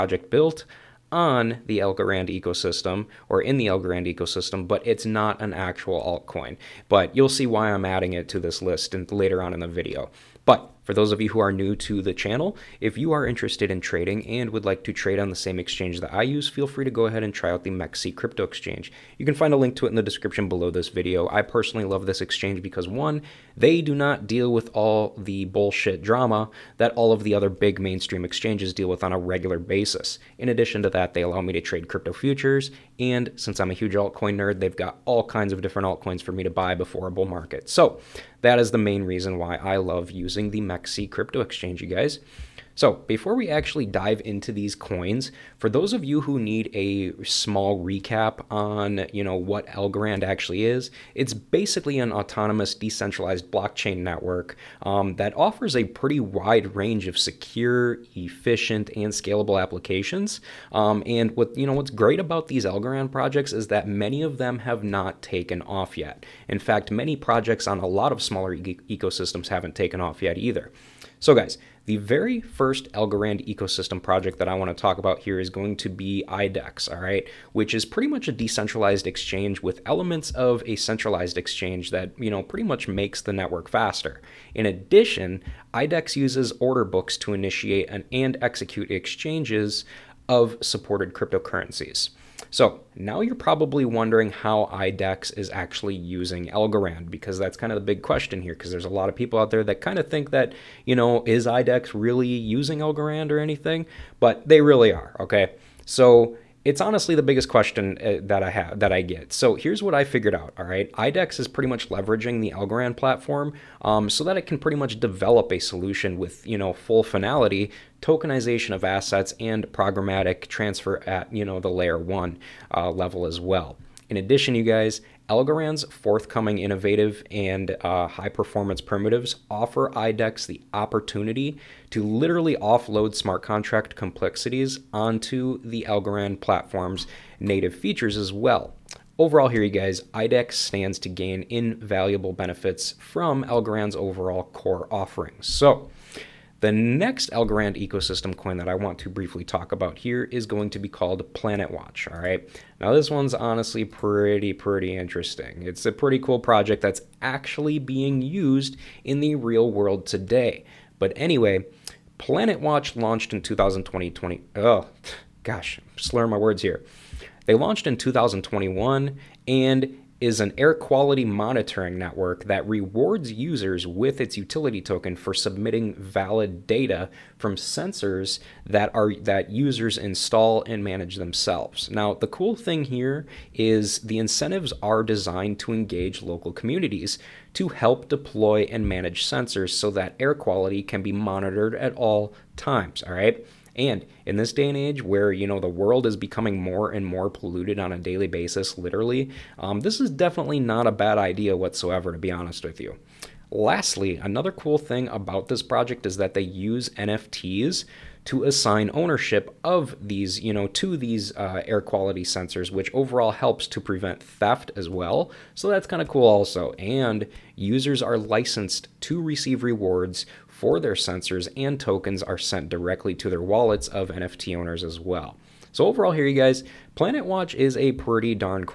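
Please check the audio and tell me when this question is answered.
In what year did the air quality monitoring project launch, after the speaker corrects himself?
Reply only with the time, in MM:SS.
02:47.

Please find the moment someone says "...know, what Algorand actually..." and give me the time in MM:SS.
00:49.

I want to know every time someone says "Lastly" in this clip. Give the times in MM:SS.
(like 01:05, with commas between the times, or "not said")
03:23.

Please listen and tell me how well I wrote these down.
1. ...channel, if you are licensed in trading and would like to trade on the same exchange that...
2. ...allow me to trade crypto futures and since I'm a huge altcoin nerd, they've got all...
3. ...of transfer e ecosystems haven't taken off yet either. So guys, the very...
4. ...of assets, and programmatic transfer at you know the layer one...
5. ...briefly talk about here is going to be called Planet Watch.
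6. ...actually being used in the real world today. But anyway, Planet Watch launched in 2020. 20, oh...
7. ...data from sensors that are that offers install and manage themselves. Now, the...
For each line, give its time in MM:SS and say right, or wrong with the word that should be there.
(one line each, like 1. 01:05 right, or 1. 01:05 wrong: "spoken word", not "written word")
1. 00:12 wrong: "interested", not "licensed"
2. 00:31 right
3. 01:08 wrong: "smaller", not "transfer"
4. 01:58 right
5. 02:29 right
6. 02:37 right
7. 02:56 wrong: "users", not "offers".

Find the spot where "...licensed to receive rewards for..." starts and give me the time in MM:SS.
03:38.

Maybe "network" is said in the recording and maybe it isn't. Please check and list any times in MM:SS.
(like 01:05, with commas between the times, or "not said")
00:53, 01:23, 02:51.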